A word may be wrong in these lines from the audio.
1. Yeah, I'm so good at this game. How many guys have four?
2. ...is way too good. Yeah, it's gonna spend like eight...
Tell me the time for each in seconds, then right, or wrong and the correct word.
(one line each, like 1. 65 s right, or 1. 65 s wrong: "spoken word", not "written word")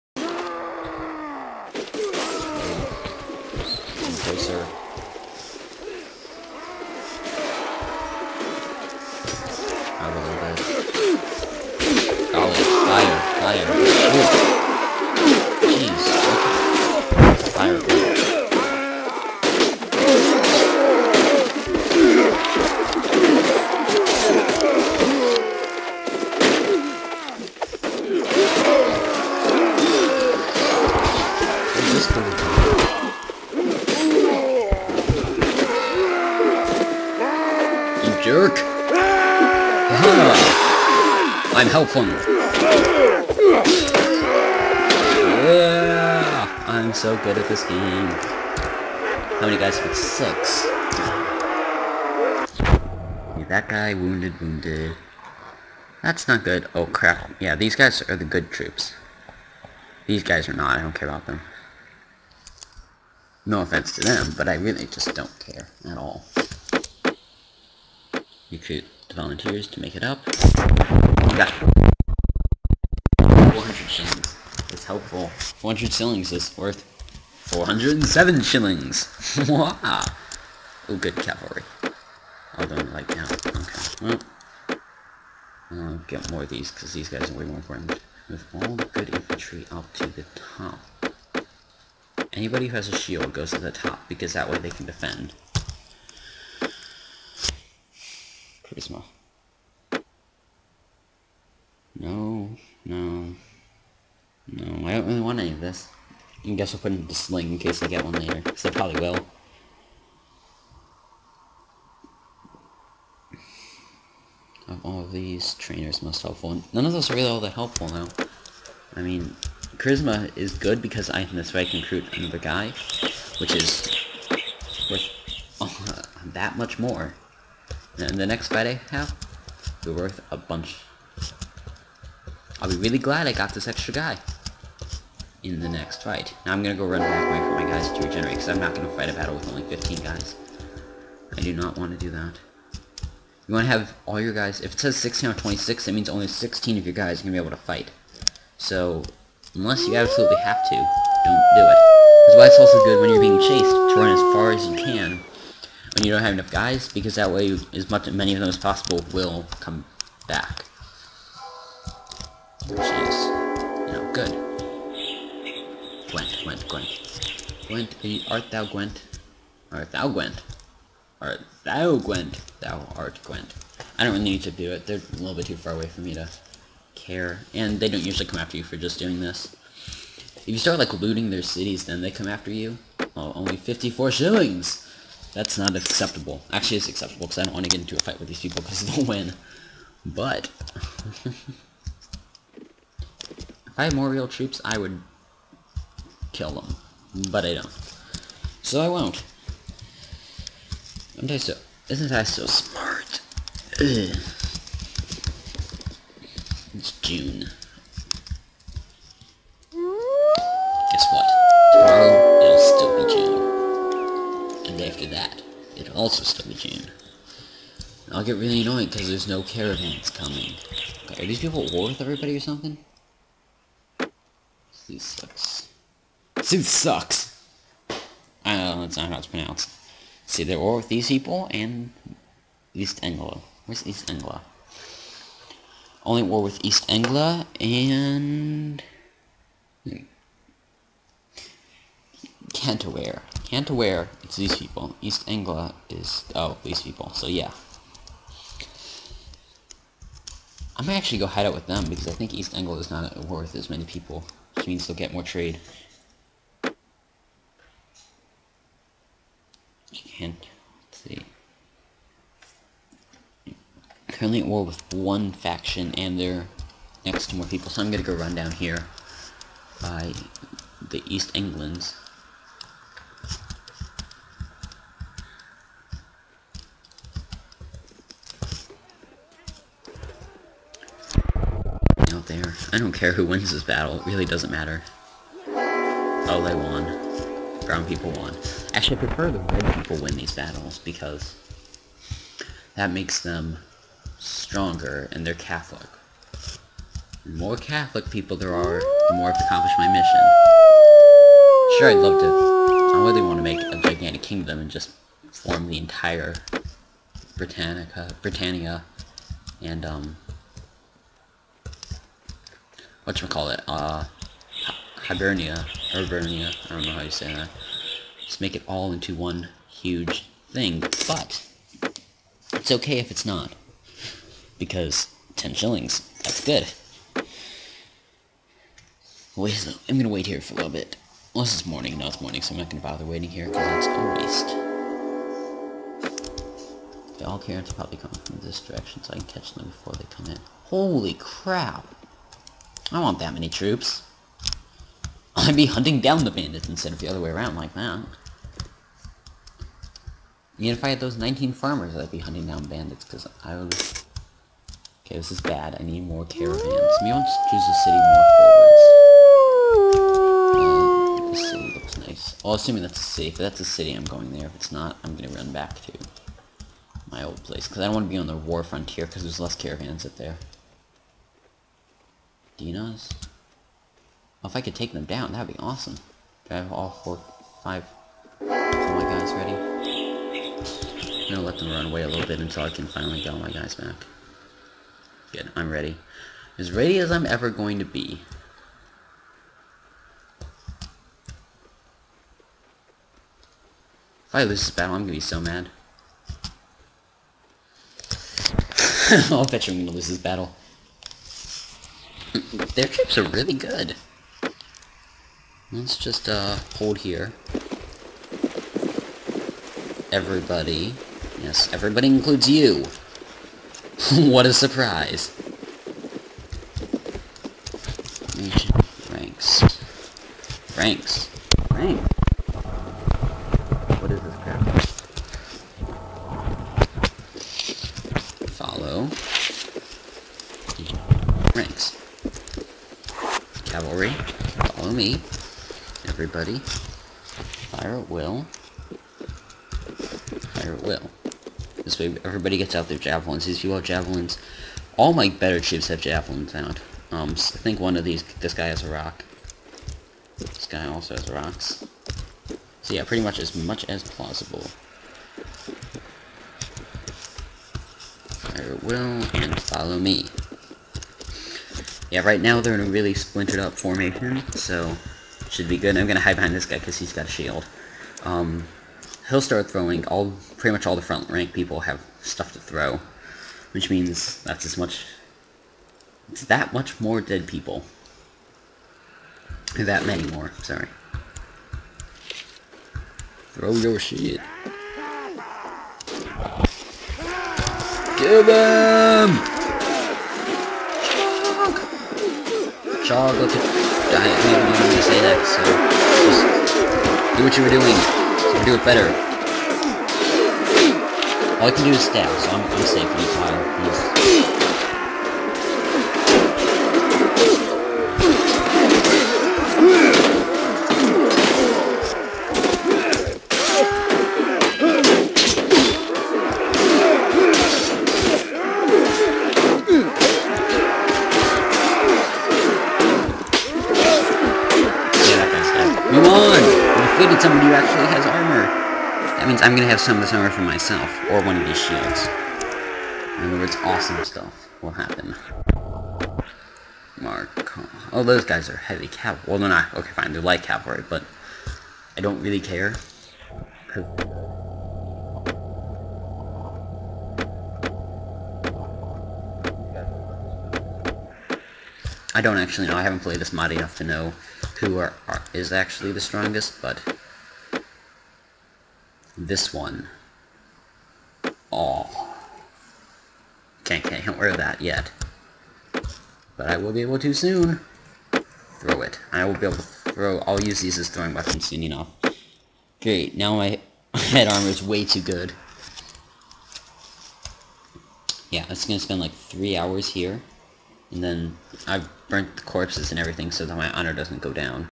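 1. 45 s wrong: "six", not "four"
2. 574 s wrong: "three", not "eight".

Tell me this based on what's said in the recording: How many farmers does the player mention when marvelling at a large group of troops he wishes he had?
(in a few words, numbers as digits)
19.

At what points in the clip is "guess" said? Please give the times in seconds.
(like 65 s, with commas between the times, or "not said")
106 s, 210 s.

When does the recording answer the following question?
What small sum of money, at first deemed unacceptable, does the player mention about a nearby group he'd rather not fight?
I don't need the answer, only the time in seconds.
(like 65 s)
183 s.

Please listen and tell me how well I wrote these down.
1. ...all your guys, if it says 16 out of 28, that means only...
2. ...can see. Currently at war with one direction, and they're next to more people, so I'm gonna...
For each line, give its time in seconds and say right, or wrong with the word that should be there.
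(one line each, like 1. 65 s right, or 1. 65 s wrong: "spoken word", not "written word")
1. 144 s wrong: "26", not "28"
2. 260 s wrong: "faction", not "direction".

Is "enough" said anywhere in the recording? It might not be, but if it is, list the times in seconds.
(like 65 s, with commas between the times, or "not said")
156 s, 553 s.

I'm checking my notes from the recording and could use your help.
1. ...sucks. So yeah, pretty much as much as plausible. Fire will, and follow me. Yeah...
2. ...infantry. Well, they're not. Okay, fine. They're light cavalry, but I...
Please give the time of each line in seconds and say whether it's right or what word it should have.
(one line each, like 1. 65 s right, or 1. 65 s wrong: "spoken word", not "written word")
1. 451 s wrong: "rocks", not "sucks"
2. 539 s wrong: "cavalry", not "infantry".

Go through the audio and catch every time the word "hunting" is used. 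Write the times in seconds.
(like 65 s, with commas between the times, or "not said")
345 s, 352 s.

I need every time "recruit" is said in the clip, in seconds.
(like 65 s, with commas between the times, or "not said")
68 s, 121 s.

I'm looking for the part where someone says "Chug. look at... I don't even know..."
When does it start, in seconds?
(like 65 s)
493 s.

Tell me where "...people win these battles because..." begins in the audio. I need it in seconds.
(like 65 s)
289 s.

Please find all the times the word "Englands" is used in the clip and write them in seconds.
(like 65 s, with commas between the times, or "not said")
271 s.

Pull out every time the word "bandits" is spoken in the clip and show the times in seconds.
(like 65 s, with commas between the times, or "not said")
346 s, 352 s.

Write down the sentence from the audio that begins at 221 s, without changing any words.
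are these people at war with everybody or something?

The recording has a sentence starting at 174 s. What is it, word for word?
They're a little bit too far away for me to care.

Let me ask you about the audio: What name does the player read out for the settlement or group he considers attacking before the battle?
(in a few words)
Dinas.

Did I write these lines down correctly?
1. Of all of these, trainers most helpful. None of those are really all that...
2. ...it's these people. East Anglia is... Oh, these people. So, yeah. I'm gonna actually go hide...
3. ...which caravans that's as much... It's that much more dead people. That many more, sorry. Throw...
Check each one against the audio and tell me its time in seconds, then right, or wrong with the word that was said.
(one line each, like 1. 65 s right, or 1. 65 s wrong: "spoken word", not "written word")
1. 114 s right
2. 244 s right
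3. 473 s wrong: "means", not "caravans".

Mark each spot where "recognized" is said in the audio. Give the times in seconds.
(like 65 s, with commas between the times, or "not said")
not said.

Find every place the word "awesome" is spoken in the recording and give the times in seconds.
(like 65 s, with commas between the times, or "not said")
375 s, 533 s.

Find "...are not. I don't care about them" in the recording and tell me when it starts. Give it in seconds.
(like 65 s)
60 s.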